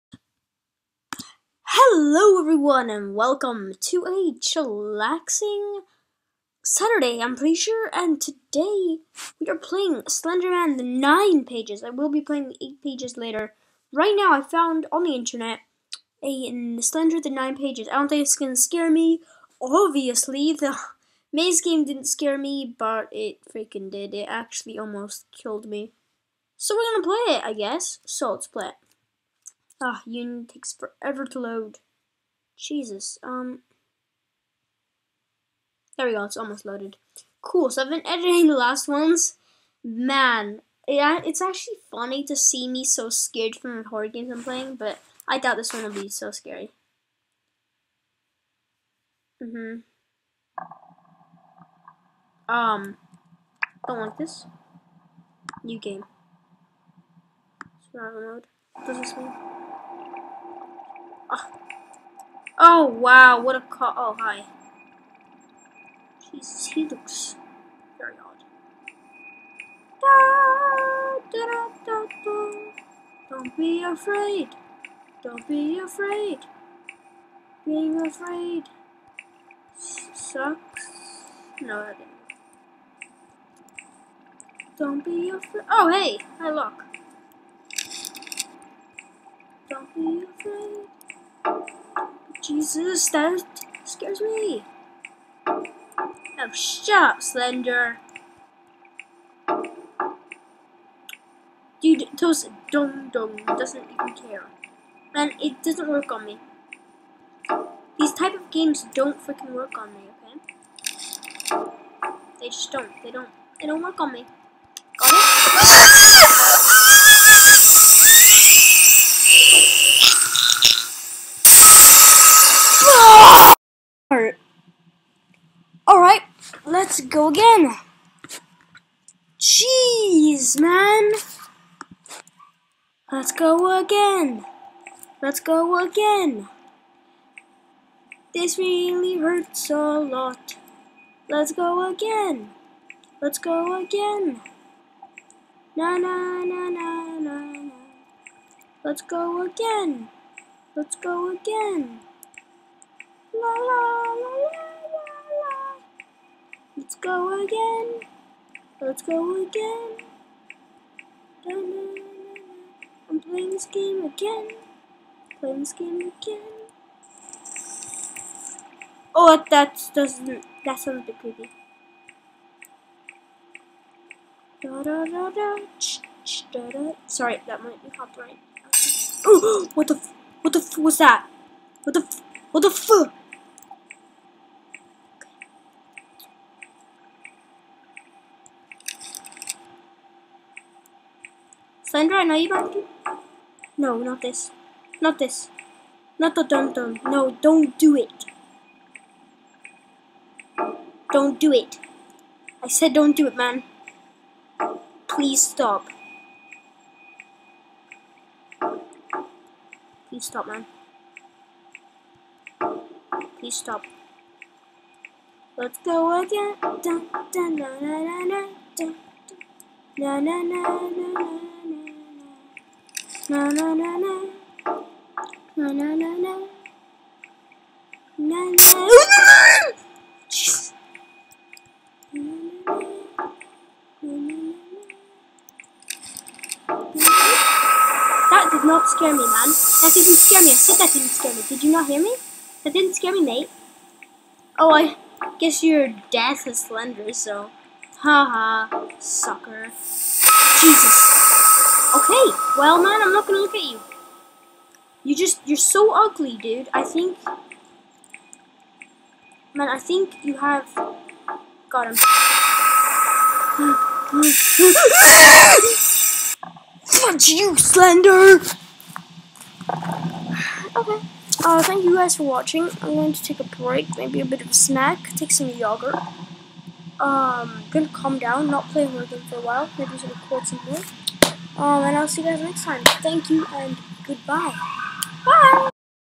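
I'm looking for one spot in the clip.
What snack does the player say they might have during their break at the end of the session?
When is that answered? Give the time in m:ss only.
4:35.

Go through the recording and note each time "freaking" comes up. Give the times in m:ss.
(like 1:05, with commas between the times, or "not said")
0:23, 1:49.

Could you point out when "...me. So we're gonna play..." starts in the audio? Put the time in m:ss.
0:25.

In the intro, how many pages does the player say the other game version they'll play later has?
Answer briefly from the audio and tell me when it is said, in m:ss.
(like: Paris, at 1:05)
8, at 0:12.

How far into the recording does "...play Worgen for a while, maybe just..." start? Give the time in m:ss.
4:38.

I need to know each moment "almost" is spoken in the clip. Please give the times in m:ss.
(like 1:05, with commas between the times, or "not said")
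0:24, 0:36.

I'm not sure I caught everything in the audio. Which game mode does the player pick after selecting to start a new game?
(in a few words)
Survival mode.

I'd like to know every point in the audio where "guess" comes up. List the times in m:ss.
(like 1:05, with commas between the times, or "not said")
0:27, 4:05.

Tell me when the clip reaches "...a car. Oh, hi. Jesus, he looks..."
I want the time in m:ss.
1:03.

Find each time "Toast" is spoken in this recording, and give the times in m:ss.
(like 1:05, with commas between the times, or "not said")
1:42.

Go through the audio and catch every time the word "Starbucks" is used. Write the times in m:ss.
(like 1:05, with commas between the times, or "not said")
not said.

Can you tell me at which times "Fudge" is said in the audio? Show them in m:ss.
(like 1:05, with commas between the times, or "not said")
4:26.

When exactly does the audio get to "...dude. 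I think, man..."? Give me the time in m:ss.
4:16.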